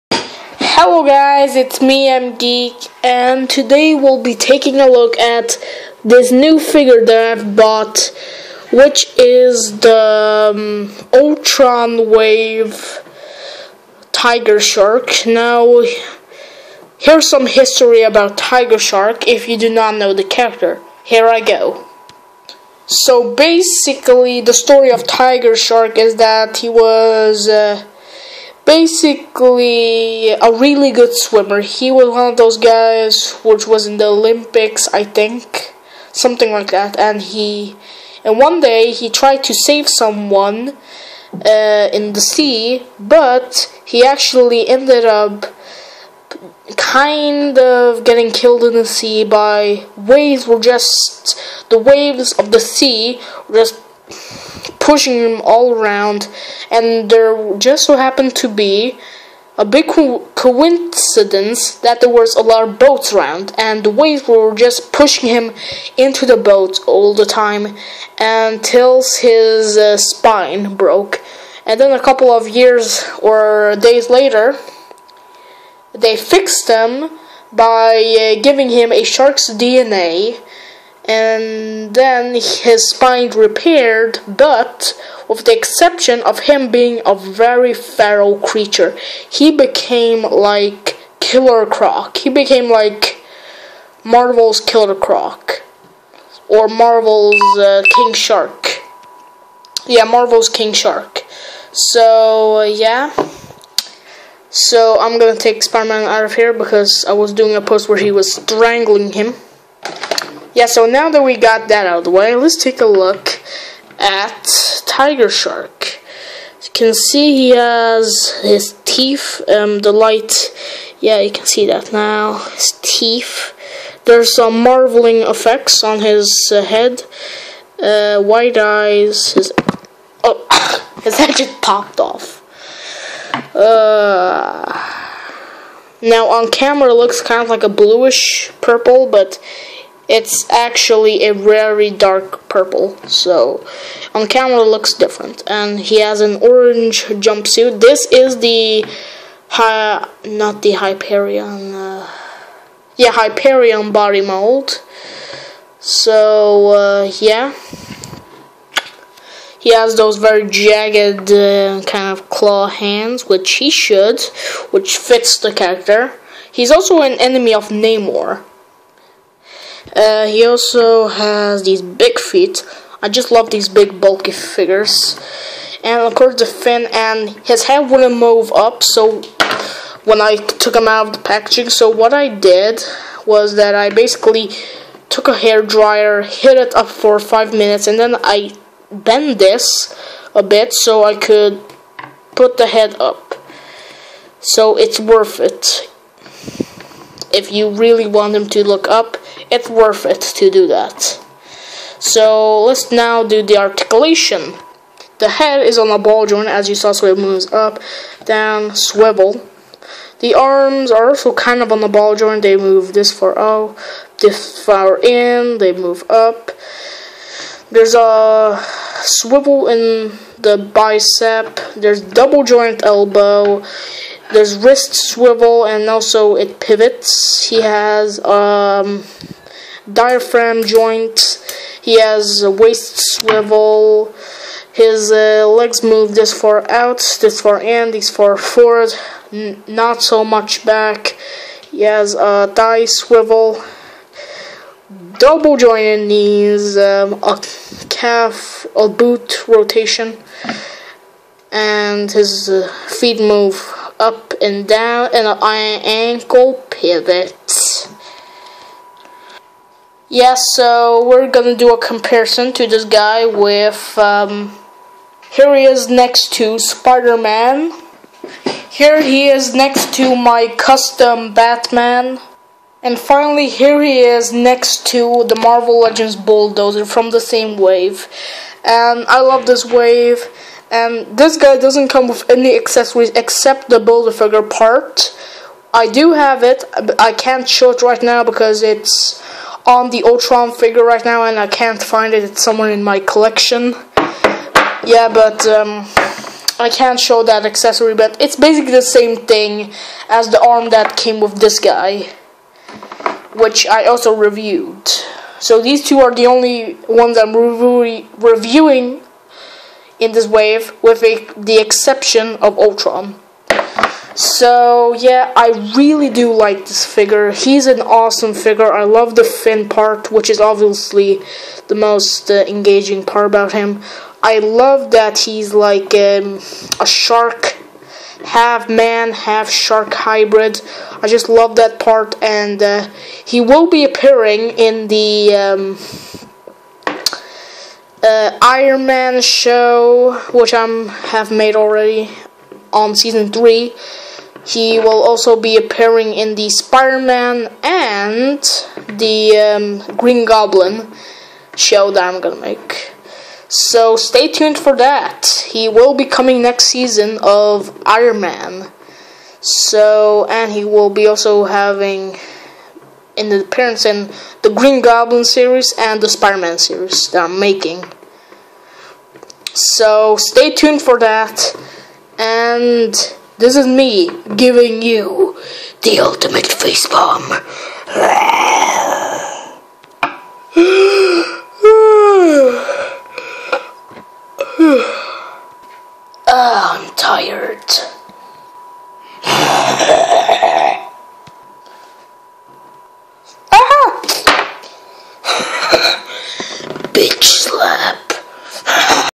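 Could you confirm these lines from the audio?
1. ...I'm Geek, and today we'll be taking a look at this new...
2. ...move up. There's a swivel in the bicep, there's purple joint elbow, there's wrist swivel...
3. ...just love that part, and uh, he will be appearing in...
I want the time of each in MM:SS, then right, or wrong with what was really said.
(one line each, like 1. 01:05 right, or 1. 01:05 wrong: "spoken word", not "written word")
1. 00:02 right
2. 03:35 wrong: "double", not "purple"
3. 05:31 right.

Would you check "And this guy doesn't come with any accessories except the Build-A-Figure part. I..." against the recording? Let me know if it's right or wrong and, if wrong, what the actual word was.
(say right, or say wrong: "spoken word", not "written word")
right.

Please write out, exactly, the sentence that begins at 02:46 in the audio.
He's also an enemy of Namor.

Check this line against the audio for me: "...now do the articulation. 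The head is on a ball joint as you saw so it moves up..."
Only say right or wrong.
right.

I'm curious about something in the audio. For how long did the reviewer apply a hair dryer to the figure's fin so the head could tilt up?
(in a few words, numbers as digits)
5 minutes.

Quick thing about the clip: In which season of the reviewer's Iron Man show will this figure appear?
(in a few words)
Season 3.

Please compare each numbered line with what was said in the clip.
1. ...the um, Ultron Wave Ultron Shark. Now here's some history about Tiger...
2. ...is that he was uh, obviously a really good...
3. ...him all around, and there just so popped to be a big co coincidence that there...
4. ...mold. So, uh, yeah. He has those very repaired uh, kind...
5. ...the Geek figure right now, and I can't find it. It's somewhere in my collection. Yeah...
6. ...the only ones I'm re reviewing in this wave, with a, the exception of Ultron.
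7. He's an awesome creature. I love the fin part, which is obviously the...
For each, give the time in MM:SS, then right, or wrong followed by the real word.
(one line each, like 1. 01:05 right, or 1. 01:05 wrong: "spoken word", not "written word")
1. 00:09 wrong: "Tiger", not "Ultron"
2. 00:25 wrong: "basically", not "obviously"
3. 00:55 wrong: "happened", not "popped"
4. 02:34 wrong: "jagged", not "repaired"
5. 04:49 wrong: "Ultron", not "Geek"
6. 05:06 right
7. 05:17 wrong: "figure", not "creature".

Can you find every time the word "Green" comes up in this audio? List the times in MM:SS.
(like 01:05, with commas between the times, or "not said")
05:49, 06:04.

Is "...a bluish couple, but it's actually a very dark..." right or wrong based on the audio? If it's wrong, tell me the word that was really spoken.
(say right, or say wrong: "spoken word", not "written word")
wrong: "purple", not "couple".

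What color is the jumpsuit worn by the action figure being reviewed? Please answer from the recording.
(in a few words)
Orange.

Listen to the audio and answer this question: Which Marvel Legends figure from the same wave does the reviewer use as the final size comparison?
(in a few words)
Bulldozer.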